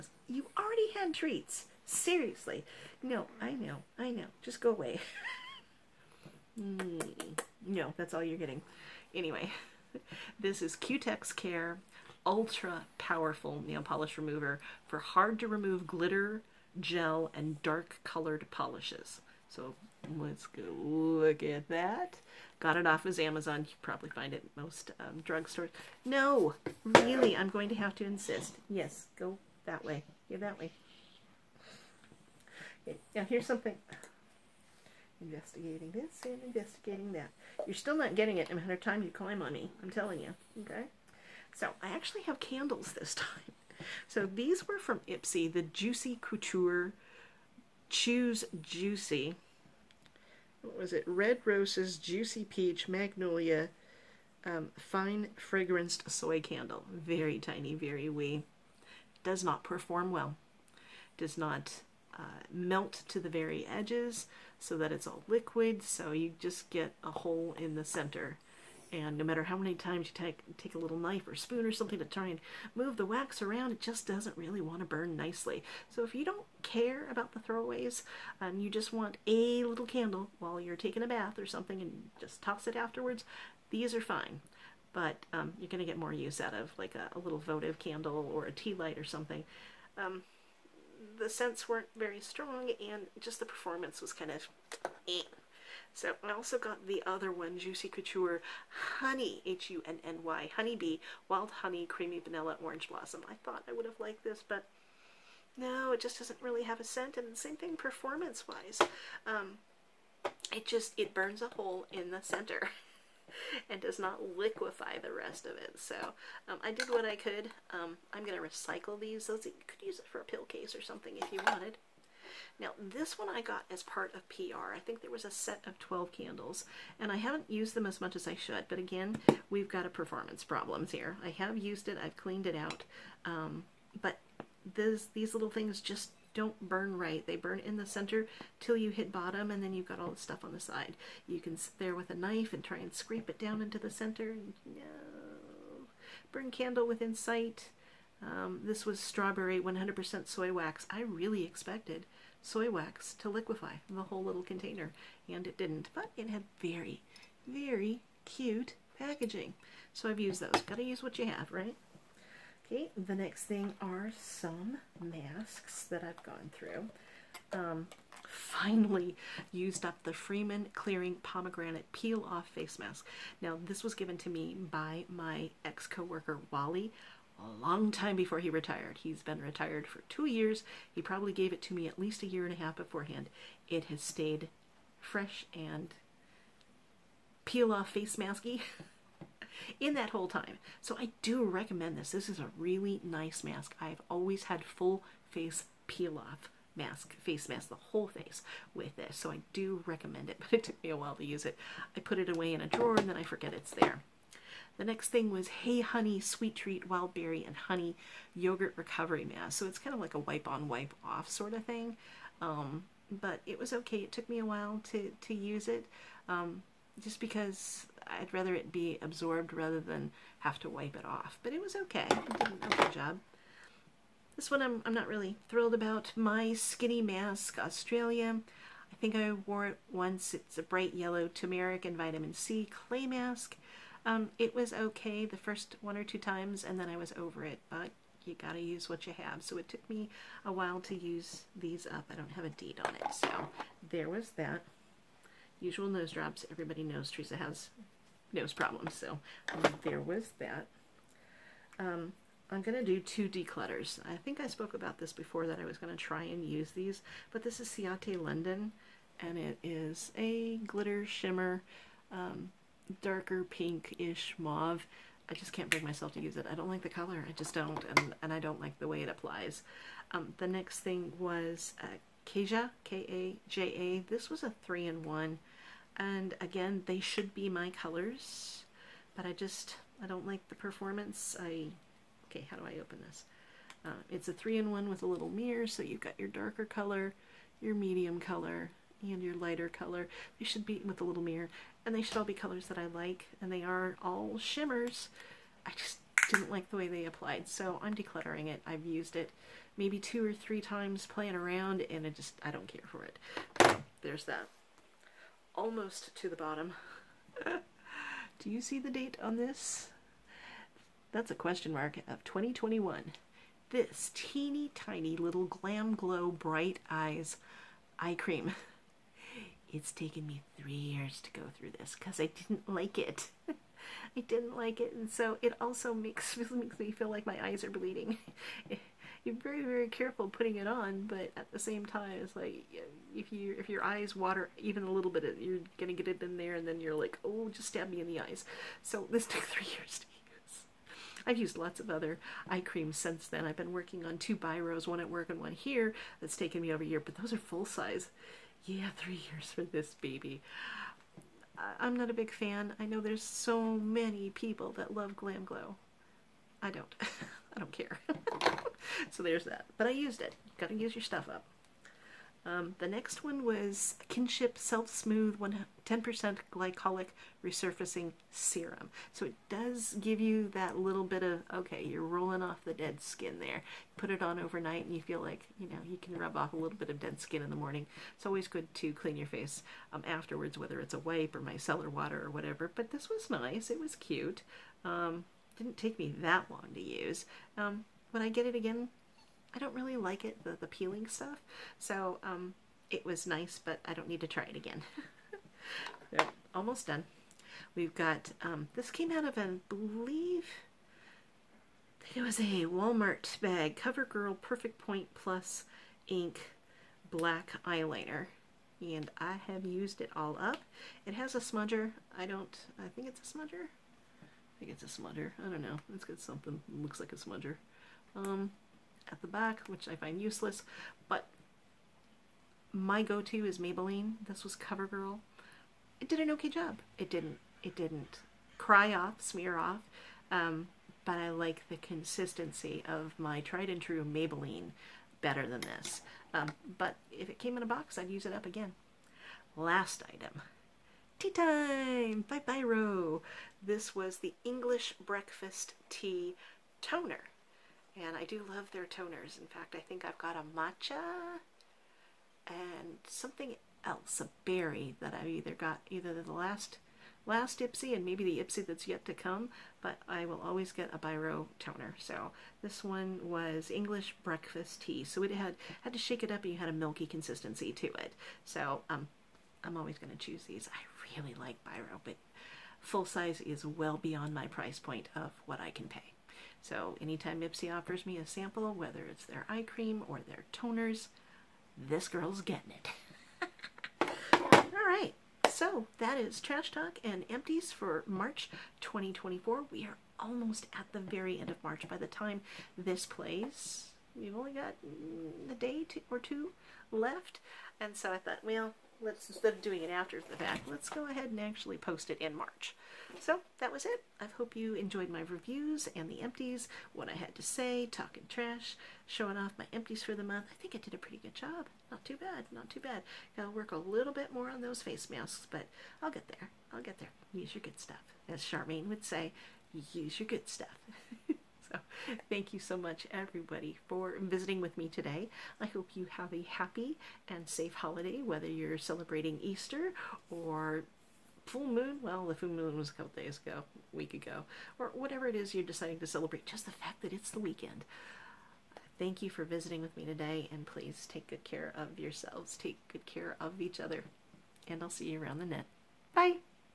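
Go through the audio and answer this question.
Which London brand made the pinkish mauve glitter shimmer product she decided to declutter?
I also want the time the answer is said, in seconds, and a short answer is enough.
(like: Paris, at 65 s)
Ciate London, at 257 s.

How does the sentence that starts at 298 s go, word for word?
I've used it maybe two or three times playing around, and I just, I don't care for it.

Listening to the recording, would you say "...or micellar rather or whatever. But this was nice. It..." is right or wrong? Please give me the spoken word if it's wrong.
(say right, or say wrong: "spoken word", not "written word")
wrong: "water", not "rather".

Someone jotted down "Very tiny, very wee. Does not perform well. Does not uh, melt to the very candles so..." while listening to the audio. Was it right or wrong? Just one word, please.
wrong.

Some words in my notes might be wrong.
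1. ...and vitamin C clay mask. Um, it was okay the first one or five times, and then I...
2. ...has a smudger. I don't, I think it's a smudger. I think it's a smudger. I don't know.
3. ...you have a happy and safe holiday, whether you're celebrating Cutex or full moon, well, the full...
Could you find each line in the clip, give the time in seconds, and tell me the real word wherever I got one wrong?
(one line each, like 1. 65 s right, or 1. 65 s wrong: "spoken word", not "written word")
1. 231 s wrong: "two", not "five"
2. 411 s right
3. 525 s wrong: "Easter", not "Cutex".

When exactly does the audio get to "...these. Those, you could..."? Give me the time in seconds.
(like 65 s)
118 s.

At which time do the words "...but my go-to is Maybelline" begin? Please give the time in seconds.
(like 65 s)
421 s.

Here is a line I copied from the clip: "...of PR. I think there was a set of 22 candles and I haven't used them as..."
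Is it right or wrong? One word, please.
wrong.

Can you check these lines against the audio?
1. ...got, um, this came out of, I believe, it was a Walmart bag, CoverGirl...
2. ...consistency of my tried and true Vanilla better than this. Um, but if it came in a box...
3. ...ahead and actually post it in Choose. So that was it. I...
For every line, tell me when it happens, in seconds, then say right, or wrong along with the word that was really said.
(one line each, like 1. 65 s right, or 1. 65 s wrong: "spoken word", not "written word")
1. 397 s right
2. 431 s wrong: "Maybelline", not "Vanilla"
3. 501 s wrong: "March", not "Choose".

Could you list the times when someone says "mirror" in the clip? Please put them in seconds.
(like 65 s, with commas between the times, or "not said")
285 s, 291 s.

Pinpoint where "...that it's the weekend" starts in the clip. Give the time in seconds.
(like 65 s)
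537 s.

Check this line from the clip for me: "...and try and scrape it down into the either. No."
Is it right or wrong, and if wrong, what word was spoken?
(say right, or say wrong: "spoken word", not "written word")
wrong: "center", not "either".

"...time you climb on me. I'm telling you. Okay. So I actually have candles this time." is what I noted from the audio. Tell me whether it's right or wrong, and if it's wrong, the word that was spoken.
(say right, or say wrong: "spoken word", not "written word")
right.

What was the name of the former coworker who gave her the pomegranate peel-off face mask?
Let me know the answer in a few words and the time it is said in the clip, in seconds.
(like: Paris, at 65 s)
Wally, at 176 s.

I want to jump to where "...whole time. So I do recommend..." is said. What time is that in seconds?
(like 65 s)
190 s.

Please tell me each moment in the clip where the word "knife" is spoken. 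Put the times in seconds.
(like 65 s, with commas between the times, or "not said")
70 s, 142 s.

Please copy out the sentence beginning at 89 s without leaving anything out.
Um, the scents weren't very strong and just the performance was kind of eh.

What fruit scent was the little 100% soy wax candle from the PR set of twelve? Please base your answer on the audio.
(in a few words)
strawberry.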